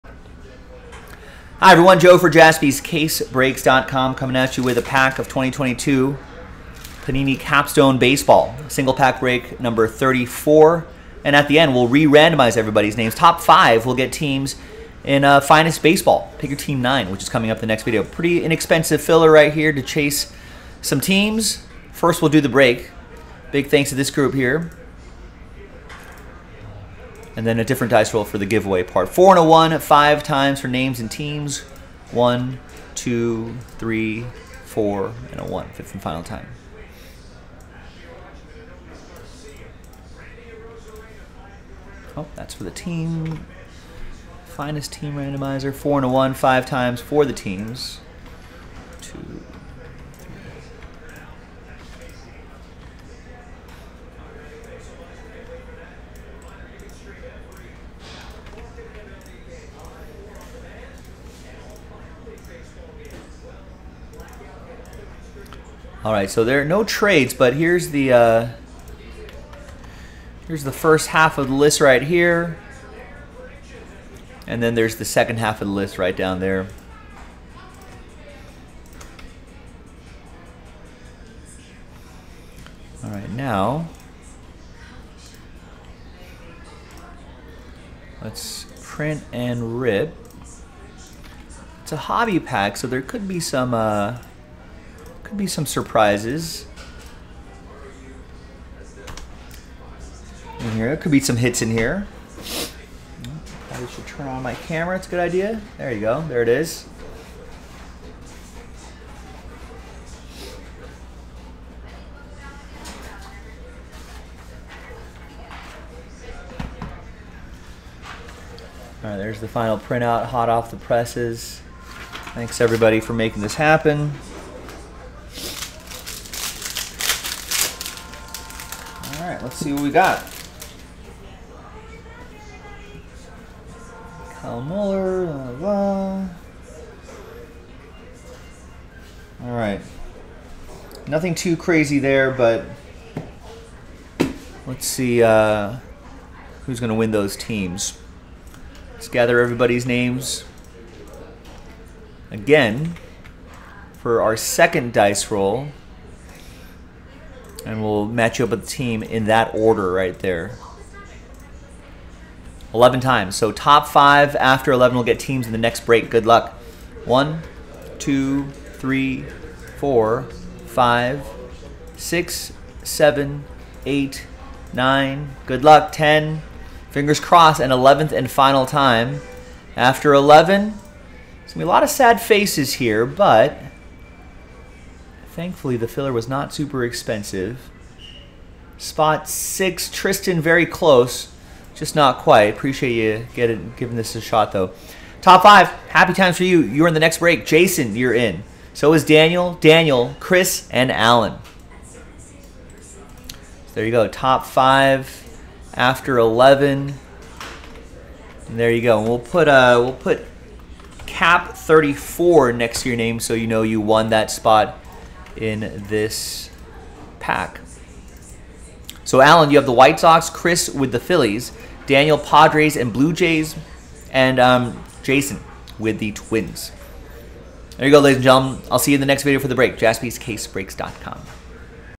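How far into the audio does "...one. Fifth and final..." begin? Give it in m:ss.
0:35.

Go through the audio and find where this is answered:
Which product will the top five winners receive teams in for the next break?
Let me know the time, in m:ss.
0:15.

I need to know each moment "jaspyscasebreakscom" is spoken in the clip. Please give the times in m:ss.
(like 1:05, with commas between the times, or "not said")
0:02, 3:49.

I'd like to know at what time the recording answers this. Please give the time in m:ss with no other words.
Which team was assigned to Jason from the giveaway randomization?
3:46.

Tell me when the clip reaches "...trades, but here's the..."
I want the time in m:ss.
1:06.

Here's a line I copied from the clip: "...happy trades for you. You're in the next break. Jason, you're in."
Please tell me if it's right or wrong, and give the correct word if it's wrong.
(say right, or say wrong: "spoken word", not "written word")
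wrong: "times", not "trades".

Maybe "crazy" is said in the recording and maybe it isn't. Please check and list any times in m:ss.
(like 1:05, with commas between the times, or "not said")
2:21.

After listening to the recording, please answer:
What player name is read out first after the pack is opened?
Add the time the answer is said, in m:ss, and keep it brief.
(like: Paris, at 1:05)
Kyle Muller, at 2:14.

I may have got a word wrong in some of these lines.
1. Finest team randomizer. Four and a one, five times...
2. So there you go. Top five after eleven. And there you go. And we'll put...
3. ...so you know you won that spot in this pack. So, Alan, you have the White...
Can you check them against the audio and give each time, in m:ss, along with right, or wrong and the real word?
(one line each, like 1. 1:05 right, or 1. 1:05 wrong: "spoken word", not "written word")
1. 0:44 right
2. 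3:21 right
3. 3:33 right.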